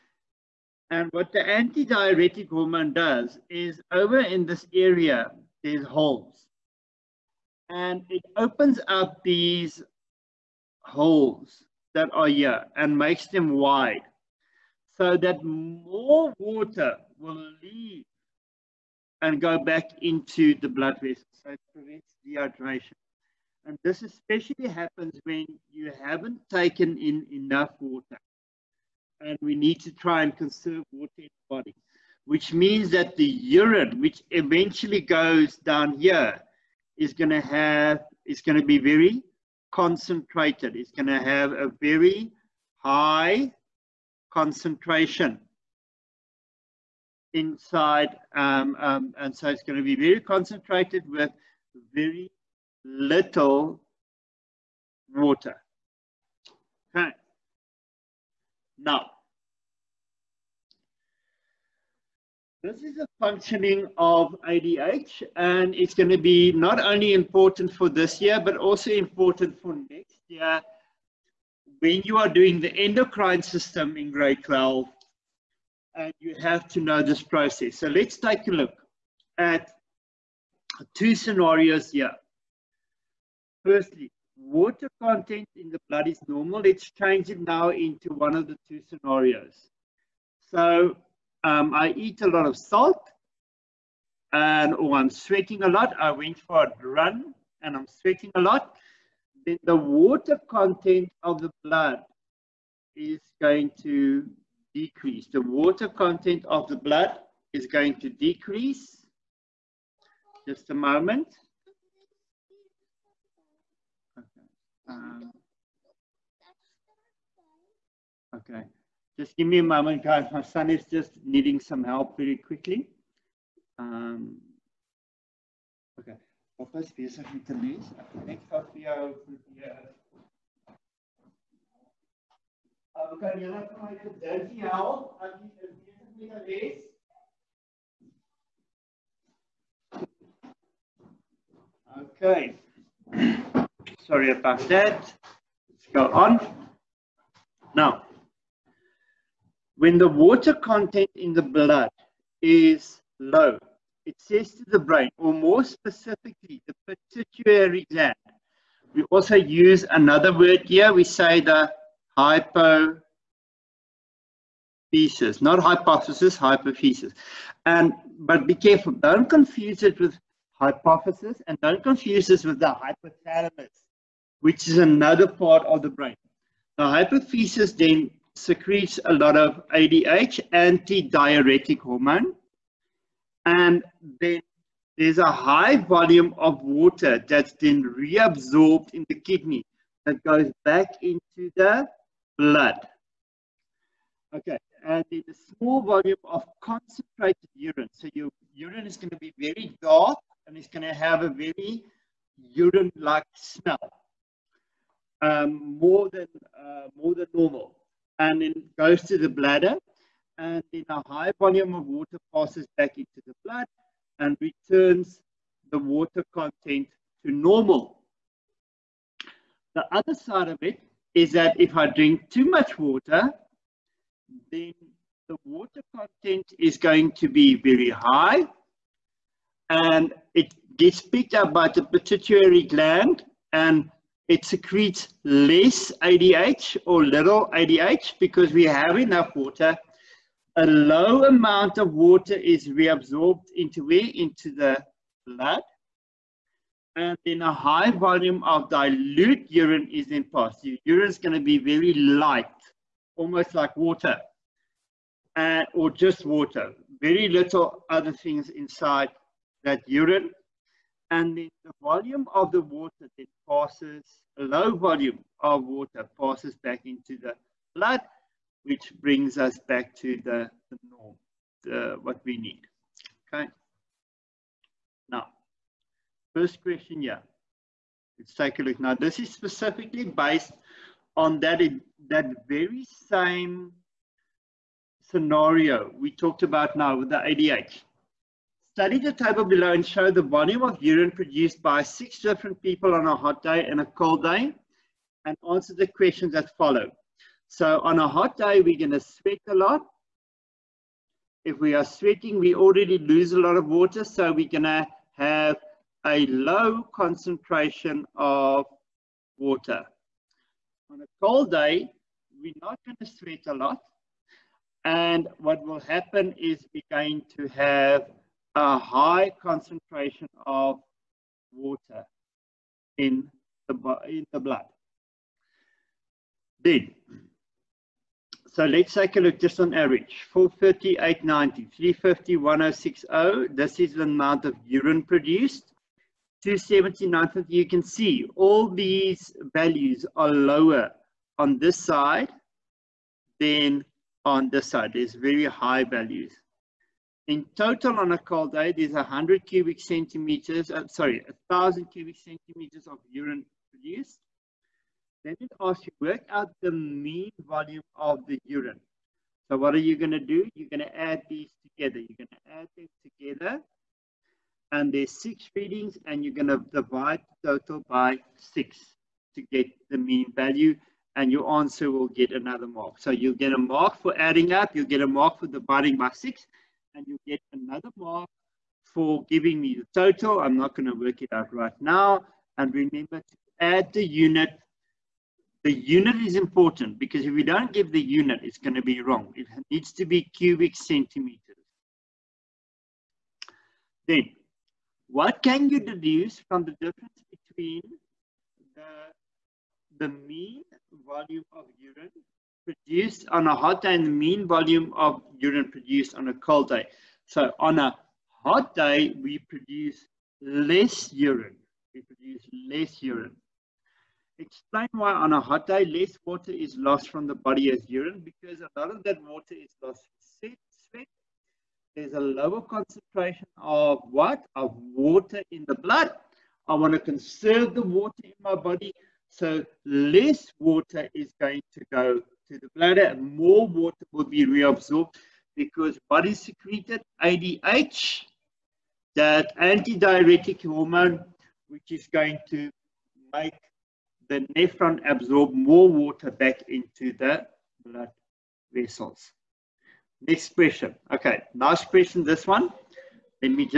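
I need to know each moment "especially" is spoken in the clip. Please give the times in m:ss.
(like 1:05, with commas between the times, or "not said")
0:24.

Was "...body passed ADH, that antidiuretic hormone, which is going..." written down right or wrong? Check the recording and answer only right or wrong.
wrong.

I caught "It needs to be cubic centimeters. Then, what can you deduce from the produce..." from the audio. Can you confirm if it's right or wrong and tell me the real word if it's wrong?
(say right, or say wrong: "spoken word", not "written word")
wrong: "difference", not "produce".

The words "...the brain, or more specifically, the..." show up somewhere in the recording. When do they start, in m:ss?
2:34.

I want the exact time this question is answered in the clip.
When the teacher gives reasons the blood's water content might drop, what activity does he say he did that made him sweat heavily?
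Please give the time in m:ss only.
1:35.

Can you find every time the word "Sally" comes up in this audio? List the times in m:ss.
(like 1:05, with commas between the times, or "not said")
not said.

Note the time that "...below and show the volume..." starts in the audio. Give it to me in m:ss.
4:49.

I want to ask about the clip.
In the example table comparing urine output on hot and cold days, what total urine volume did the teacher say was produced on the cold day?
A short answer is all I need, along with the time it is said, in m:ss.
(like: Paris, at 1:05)
1,000 cubic centimeters, at 5:51.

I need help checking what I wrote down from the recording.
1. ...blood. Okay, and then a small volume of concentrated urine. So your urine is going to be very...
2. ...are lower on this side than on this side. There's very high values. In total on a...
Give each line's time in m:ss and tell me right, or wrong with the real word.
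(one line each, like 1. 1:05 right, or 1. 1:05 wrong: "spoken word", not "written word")
1. 3:12 right
2. 5:40 right.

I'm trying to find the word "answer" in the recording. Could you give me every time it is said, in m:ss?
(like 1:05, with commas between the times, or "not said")
4:55, 6:11.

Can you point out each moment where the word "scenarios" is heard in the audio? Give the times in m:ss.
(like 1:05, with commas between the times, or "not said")
1:21, 1:28, 4:45.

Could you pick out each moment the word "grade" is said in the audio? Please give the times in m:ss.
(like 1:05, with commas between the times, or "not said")
1:14.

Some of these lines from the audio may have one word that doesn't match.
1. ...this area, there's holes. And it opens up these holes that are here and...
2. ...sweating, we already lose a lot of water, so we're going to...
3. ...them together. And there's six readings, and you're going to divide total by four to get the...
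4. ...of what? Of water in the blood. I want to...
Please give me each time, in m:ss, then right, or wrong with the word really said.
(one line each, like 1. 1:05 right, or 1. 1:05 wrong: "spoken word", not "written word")
1. 0:04 right
2. 5:01 right
3. 6:02 wrong: "six", not "four"
4. 7:03 right.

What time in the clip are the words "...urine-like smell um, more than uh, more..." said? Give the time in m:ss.
3:22.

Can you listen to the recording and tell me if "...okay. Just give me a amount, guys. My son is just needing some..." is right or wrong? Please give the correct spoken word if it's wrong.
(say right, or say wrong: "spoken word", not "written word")
wrong: "moment", not "amount".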